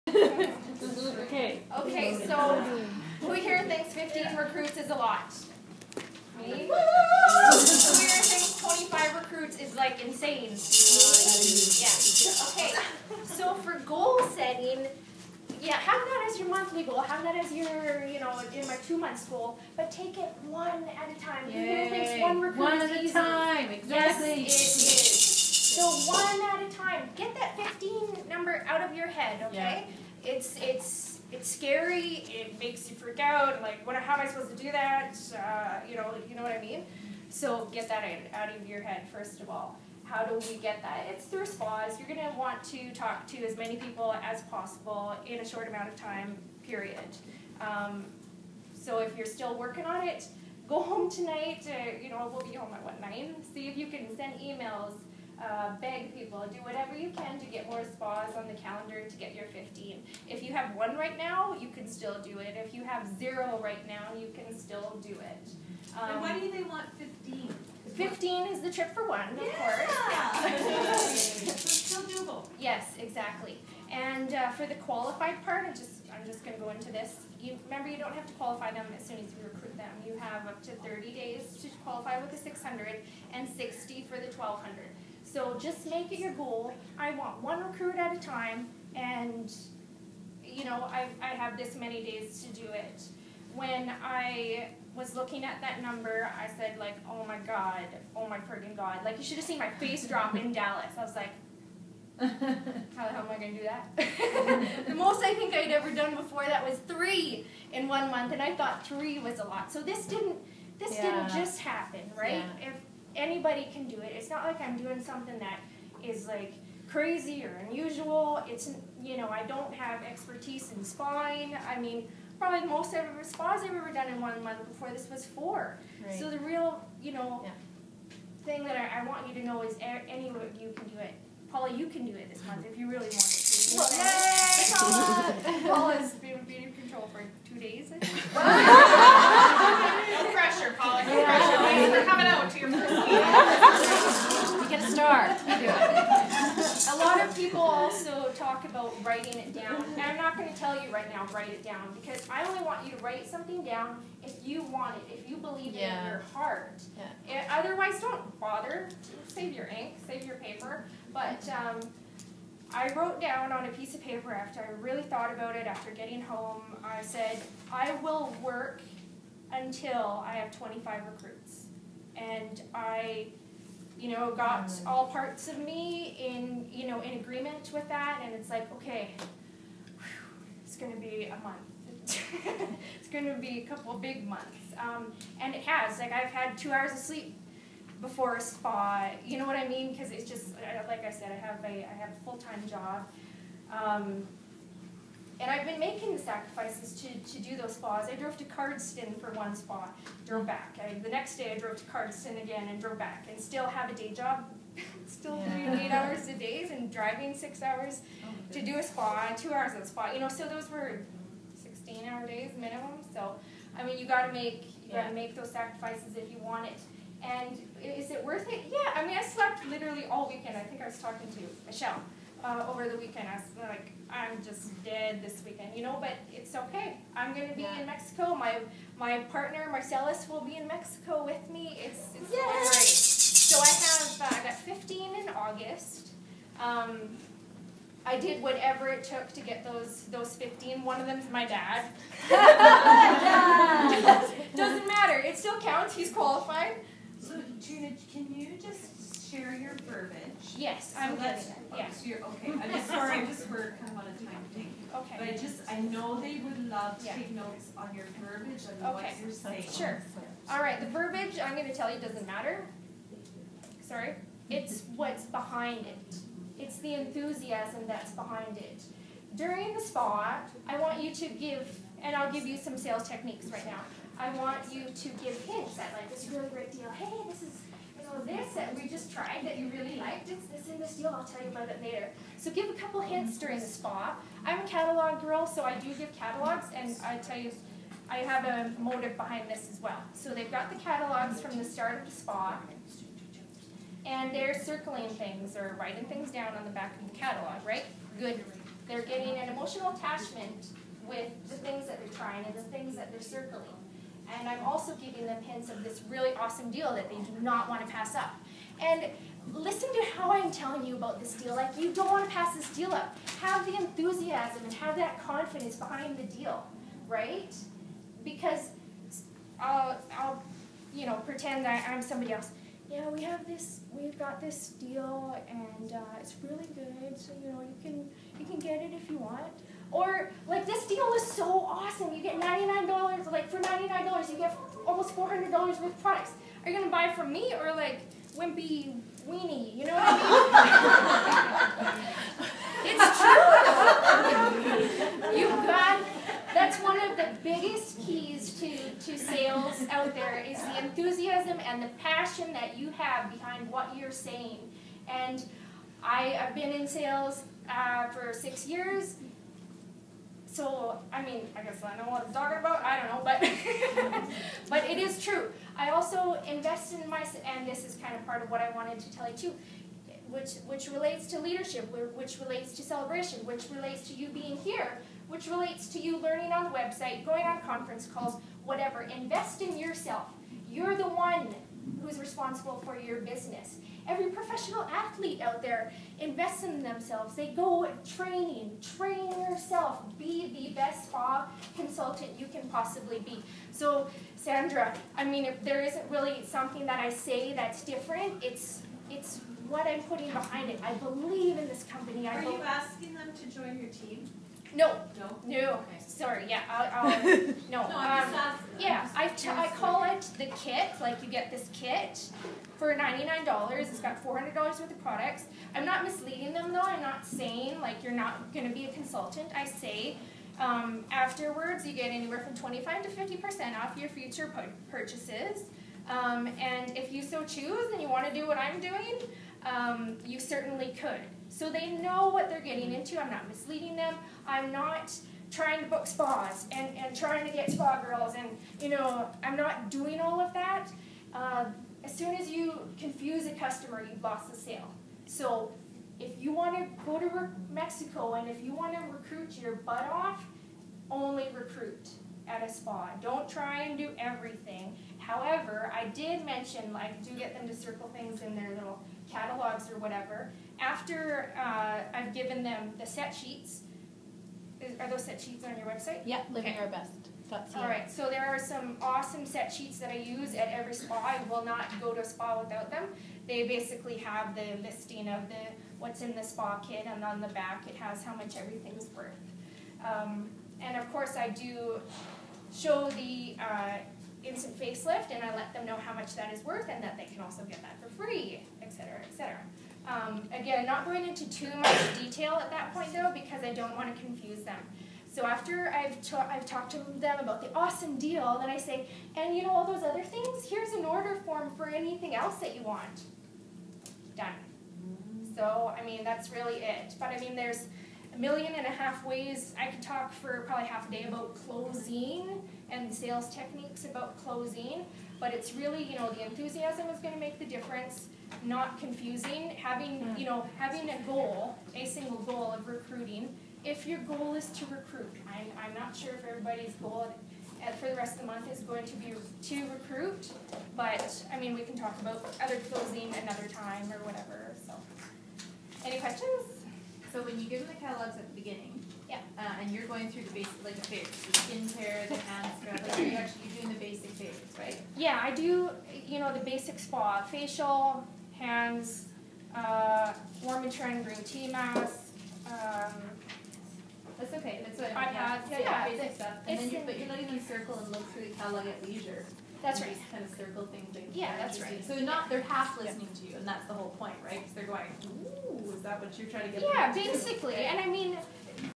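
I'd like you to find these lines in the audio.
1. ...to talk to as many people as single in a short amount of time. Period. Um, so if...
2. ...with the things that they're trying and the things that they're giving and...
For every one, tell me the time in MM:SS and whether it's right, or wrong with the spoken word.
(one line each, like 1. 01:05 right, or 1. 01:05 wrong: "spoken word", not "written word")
1. 00:42 wrong: "possible", not "single"
2. 05:01 wrong: "circling", not "giving".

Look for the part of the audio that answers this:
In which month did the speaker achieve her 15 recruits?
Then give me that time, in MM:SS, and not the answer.
03:55.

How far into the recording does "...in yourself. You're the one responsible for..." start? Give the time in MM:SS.
06:19.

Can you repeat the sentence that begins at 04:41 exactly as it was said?
I'll tell you about it later.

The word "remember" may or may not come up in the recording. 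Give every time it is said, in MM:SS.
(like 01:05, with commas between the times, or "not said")
01:17.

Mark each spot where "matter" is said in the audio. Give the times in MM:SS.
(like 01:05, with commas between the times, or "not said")
04:04, 04:22.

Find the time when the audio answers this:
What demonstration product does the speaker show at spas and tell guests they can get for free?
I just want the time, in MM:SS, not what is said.
08:04.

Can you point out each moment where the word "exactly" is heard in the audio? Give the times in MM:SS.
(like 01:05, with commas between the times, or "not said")
00:23, 01:12.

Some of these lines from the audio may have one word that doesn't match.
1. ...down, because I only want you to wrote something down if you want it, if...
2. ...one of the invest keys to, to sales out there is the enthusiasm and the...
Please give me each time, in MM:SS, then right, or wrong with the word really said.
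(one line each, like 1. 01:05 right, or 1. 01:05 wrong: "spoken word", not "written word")
1. 02:31 wrong: "write", not "wrote"
2. 05:46 wrong: "biggest", not "invest".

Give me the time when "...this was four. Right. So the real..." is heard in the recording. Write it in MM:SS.
02:04.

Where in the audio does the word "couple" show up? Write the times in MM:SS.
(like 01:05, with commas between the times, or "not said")
03:03, 04:42.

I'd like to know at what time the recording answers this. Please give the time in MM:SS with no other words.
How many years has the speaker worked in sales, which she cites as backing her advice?
05:58.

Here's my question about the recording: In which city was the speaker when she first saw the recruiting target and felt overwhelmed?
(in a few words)
Dallas.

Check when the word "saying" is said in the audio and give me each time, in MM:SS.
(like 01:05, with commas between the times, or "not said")
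04:19, 05:54, 06:57.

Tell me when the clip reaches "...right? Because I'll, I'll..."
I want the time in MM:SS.
05:17.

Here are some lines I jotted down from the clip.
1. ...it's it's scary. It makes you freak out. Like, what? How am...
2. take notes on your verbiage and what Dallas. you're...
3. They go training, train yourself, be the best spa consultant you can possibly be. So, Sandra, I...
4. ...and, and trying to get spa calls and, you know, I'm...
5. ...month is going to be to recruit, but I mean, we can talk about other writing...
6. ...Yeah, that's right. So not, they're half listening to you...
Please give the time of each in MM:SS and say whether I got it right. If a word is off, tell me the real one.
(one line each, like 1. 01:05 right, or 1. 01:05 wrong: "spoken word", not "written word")
1. 00:30 right
2. 04:17 wrong: "Okay", not "Dallas"
3. 06:27 right
4. 07:16 wrong: "girls", not "calls"
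5. 08:48 wrong: "closing", not "writing"
6. 09:21 right.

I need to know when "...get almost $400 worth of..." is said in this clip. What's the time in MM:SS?
05:34.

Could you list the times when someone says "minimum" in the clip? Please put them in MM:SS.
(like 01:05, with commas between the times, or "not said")
03:32.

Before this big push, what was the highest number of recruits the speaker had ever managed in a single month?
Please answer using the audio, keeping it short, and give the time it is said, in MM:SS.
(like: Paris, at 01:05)
3, at 01:46.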